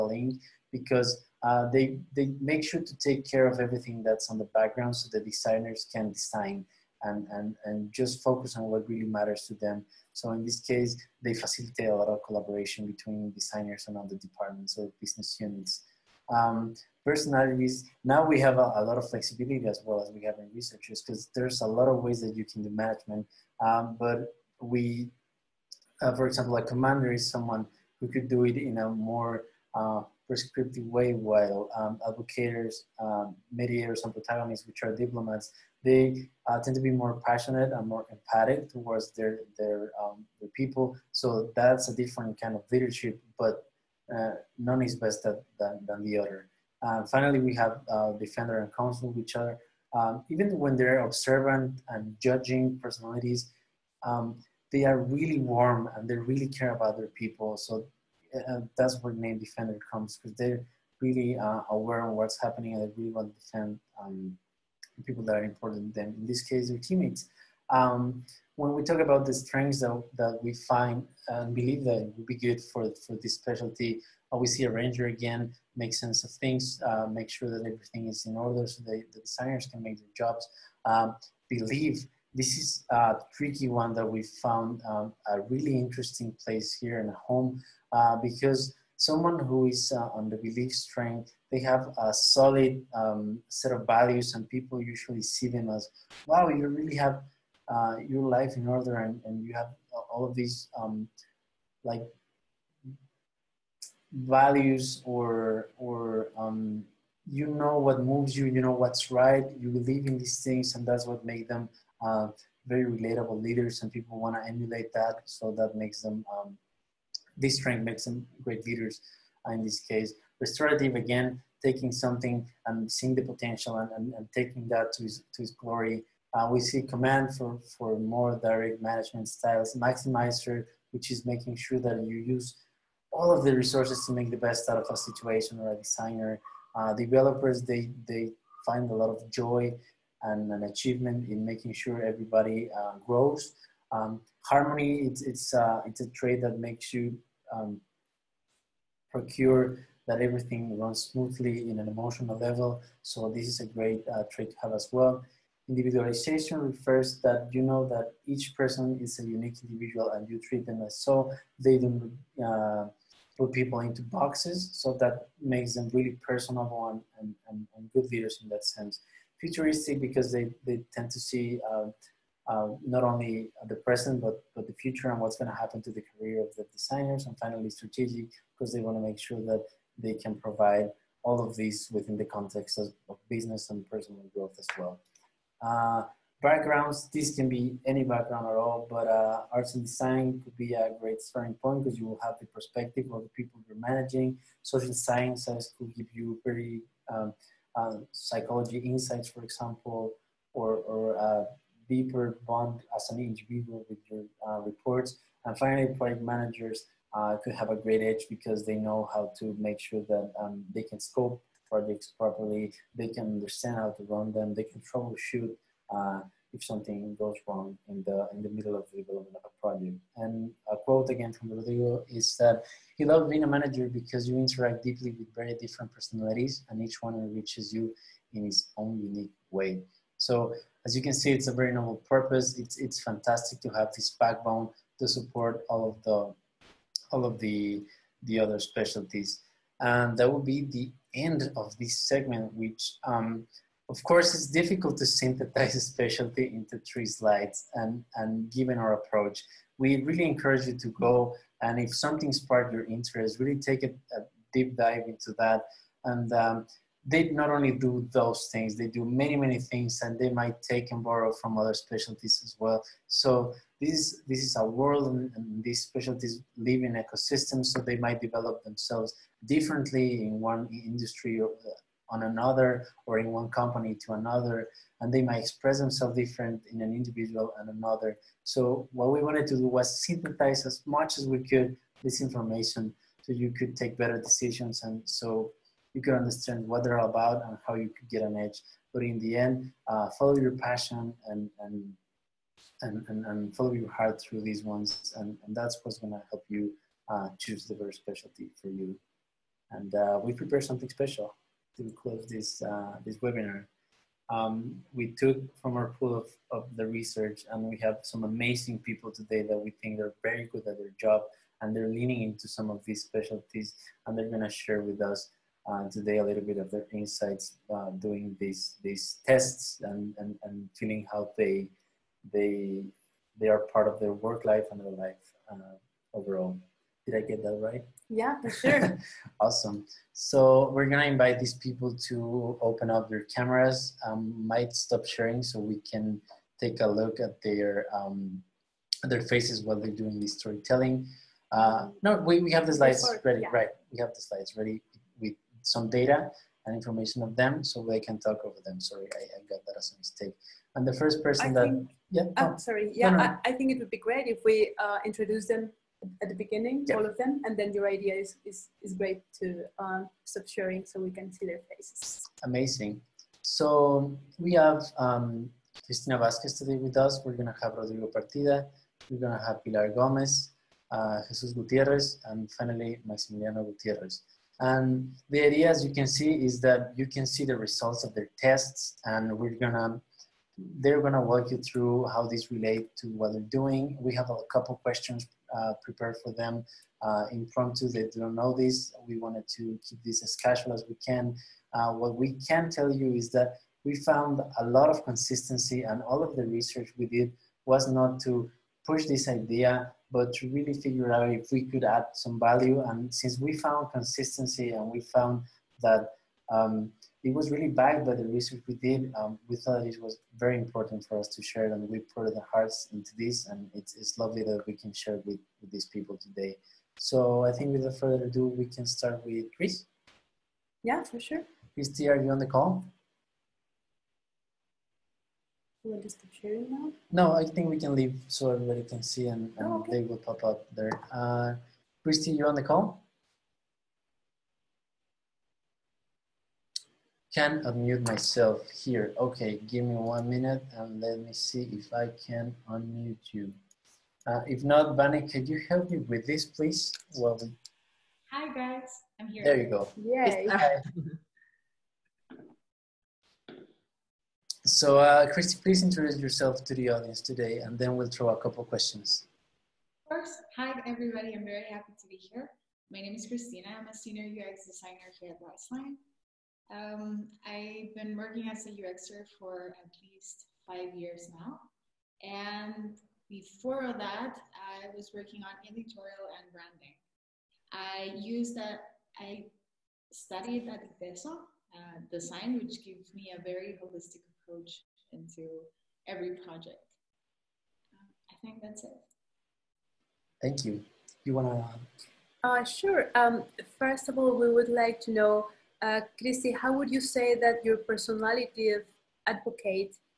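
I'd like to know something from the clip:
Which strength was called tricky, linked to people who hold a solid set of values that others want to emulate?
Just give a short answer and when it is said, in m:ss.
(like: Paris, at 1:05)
Belief, at 1:30.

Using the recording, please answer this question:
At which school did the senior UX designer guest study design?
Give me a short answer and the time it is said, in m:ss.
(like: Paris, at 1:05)
ITESO, at 8:01.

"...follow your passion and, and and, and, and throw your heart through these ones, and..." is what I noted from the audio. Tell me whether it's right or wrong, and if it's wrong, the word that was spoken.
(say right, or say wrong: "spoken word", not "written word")
wrong: "follow", not "throw".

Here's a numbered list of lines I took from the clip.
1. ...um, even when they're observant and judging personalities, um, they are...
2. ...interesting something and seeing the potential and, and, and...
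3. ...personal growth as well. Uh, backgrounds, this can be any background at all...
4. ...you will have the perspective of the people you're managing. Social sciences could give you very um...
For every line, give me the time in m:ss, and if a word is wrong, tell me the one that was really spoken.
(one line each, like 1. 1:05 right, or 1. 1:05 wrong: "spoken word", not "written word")
1. 0:49 right
2. 2:01 wrong: "taking", not "interesting"
3. 3:03 right
4. 3:11 right.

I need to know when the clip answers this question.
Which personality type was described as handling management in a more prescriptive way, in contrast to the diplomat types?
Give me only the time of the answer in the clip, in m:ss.
0:26.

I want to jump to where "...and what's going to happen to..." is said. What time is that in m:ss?
2:55.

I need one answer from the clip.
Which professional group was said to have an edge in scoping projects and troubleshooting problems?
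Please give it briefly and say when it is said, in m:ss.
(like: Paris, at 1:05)
Project managers, at 3:25.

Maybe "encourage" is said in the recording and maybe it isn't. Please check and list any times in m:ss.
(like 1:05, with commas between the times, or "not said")
4:10.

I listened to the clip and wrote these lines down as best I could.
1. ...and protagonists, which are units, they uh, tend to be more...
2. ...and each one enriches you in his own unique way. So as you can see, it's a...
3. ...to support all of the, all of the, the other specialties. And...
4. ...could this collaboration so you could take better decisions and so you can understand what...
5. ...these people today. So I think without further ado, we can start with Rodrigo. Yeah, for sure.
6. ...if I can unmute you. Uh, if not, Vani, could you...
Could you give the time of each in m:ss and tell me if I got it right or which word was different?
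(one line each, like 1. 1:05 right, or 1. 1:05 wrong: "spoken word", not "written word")
1. 0:34 wrong: "diplomats", not "units"
2. 3:46 right
3. 3:54 right
4. 4:41 wrong: "information", not "collaboration"
5. 6:55 wrong: "Chris", not "Rodrigo"
6. 7:21 right.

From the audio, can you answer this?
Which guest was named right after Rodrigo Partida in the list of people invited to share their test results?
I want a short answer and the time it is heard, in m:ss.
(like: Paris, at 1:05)
Pilar Gomez, at 6:09.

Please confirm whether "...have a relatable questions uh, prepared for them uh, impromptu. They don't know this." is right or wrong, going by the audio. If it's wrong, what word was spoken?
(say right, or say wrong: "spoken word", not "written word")
wrong: "couple", not "relatable".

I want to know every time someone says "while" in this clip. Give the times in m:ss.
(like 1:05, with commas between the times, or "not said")
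0:31, 5:39.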